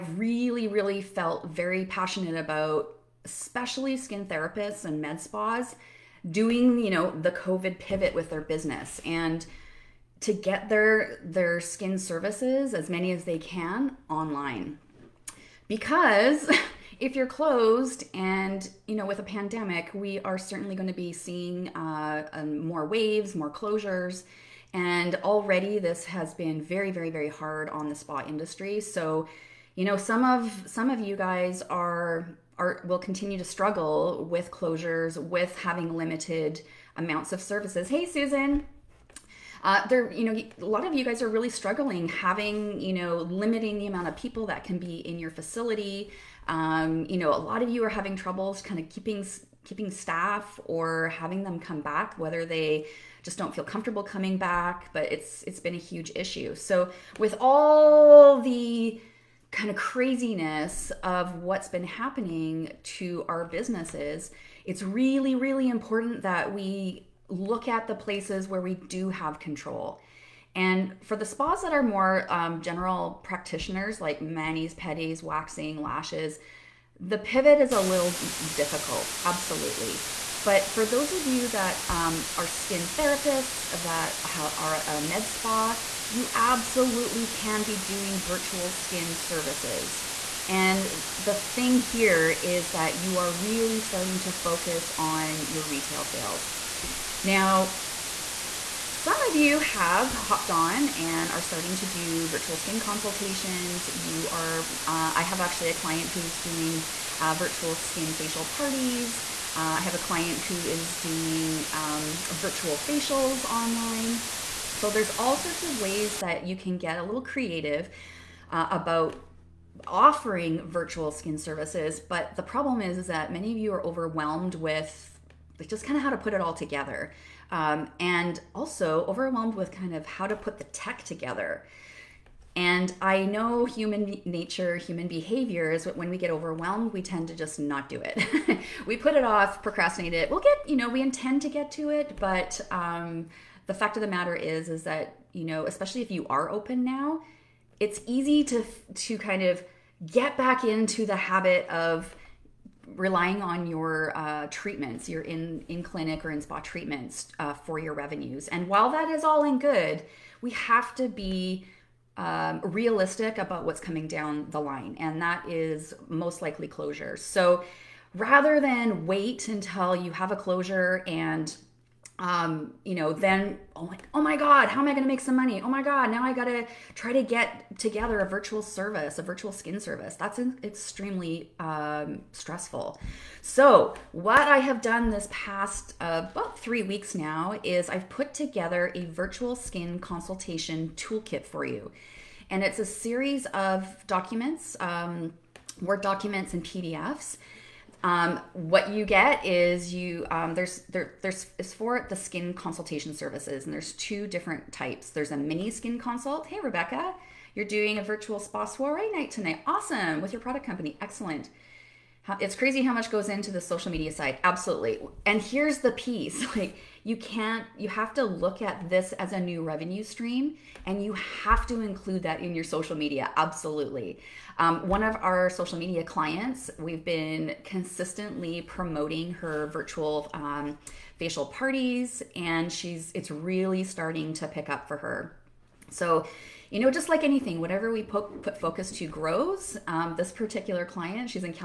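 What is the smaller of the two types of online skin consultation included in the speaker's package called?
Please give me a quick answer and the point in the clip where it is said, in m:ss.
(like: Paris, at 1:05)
mini skin consult, at 3:25.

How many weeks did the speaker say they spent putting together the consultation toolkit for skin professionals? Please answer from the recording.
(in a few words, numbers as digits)
3.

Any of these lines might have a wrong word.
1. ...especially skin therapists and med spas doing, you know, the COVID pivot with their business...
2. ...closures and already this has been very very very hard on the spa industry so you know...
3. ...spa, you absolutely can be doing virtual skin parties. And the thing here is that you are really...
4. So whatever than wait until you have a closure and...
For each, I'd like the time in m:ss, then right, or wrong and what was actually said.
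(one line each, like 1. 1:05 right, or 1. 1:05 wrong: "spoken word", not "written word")
1. 0:03 right
2. 0:23 right
3. 1:25 wrong: "services", not "parties"
4. 2:47 wrong: "rather", not "whatever".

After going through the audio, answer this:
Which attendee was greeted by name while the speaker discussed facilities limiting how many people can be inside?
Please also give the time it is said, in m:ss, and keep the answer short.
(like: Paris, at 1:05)
Susan, at 0:38.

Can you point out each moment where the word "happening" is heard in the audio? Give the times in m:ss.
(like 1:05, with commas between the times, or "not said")
1:01.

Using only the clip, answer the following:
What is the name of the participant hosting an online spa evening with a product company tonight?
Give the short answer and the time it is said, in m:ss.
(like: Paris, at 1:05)
Rebecca, at 3:26.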